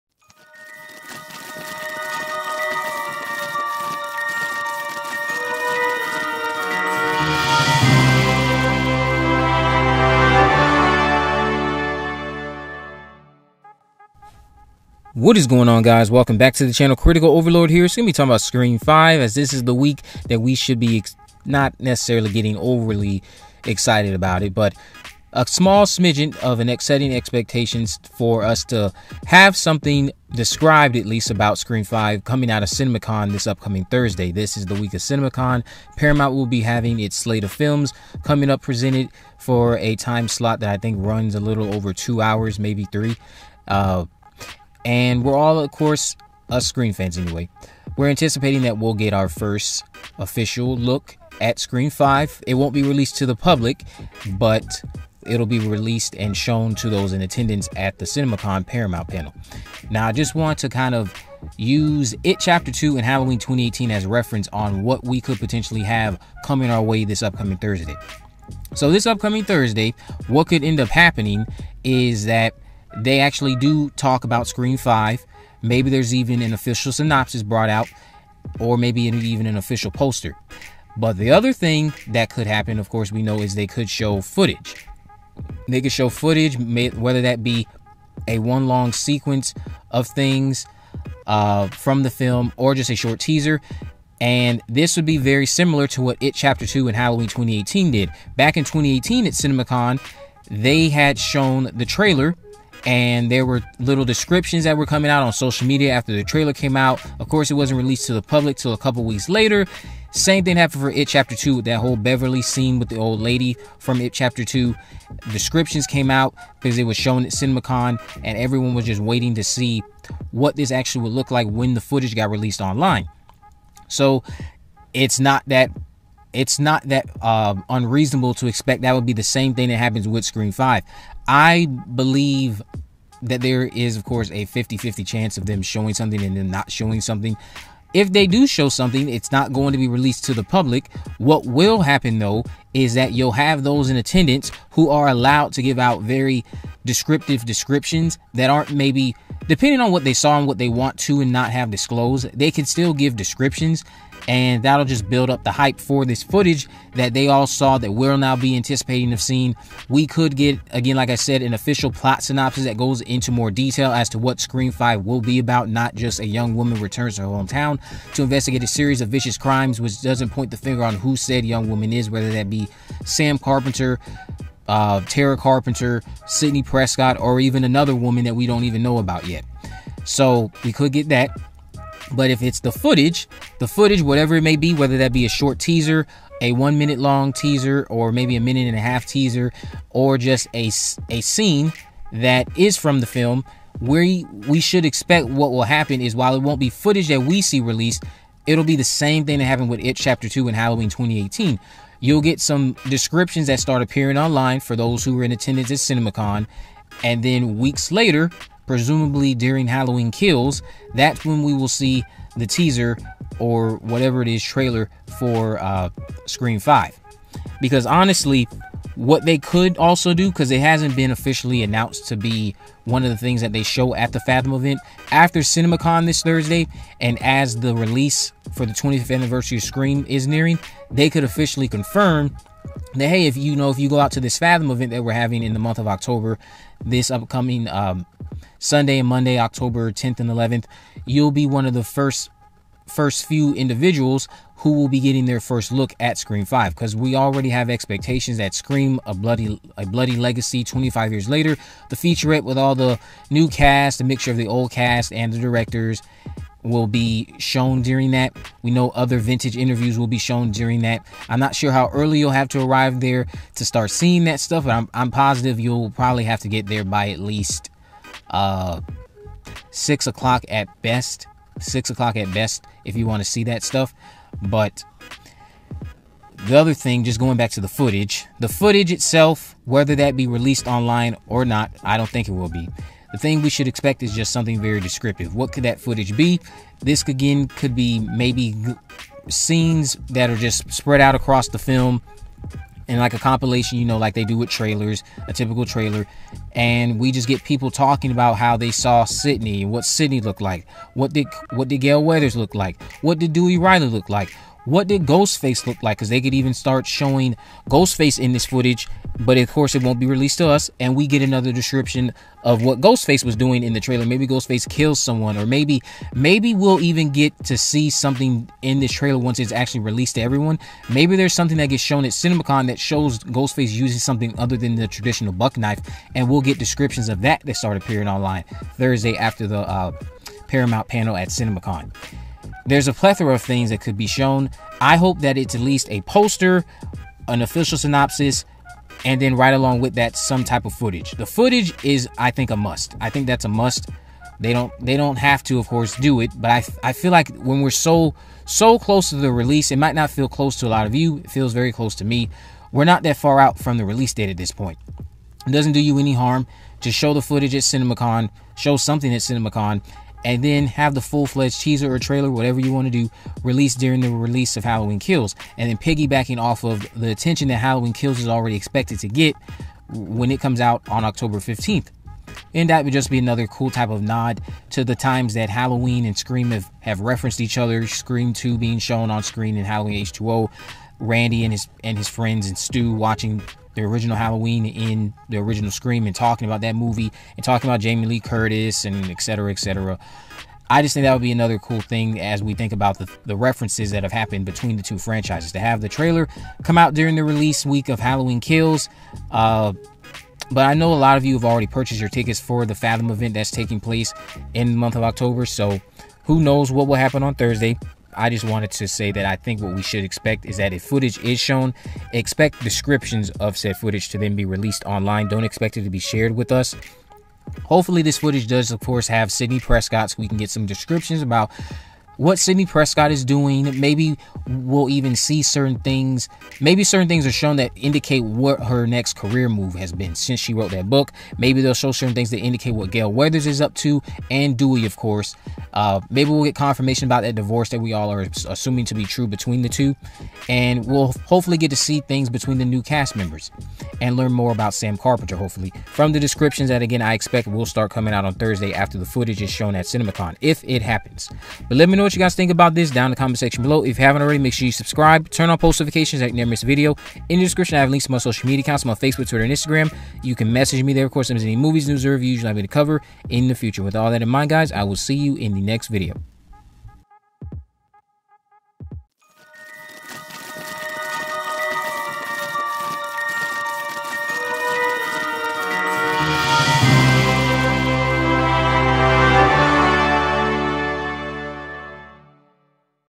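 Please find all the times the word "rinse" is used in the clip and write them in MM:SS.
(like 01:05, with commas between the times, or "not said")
not said.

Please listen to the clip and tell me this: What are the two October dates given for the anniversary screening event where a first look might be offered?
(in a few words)
October 10th and 11th.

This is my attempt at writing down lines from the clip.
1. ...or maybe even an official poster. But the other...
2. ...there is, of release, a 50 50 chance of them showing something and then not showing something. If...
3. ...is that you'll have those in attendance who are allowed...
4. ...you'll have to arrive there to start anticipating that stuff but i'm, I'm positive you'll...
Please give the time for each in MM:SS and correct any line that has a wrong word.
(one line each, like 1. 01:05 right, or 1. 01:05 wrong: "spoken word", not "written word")
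1. 01:18 right
2. 02:13 wrong: "course", not "release"
3. 02:22 right
4. 04:22 wrong: "seeing", not "anticipating".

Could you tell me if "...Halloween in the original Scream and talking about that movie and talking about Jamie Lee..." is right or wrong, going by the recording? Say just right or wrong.
right.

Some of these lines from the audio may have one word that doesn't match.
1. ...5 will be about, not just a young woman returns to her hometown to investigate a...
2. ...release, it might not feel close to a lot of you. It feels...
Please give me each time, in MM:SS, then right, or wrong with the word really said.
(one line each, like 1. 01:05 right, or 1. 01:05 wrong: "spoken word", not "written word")
1. 02:44 right
2. 05:49 right.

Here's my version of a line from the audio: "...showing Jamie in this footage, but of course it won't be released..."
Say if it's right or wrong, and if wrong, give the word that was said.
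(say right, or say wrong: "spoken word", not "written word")
wrong: "Ghostface", not "Jamie".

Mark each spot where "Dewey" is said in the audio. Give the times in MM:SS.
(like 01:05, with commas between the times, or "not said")
05:03, 07:14.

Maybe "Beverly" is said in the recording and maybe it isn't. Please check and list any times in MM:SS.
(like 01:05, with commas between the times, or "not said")
01:51.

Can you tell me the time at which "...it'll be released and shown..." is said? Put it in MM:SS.
00:55.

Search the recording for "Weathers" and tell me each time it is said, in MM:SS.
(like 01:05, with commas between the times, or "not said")
05:02, 07:13.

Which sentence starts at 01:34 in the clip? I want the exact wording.
And this would be very similar to what It Chapter 2 and Halloween 2018 did.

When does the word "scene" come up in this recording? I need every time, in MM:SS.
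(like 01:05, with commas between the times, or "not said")
01:52, 03:11, 04:49.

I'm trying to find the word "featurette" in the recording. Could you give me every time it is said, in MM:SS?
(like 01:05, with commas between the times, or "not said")
04:11.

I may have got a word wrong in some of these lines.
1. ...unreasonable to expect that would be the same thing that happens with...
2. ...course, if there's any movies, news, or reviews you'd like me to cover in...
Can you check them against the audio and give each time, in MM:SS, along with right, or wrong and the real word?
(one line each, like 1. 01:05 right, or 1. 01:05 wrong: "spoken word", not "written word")
1. 02:07 right
2. 07:41 right.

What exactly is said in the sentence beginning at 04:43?
The thing we should expect is just something very descriptive.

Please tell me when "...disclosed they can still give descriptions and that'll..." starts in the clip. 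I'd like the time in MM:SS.
02:31.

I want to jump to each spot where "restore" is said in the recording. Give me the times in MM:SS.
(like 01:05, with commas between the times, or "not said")
not said.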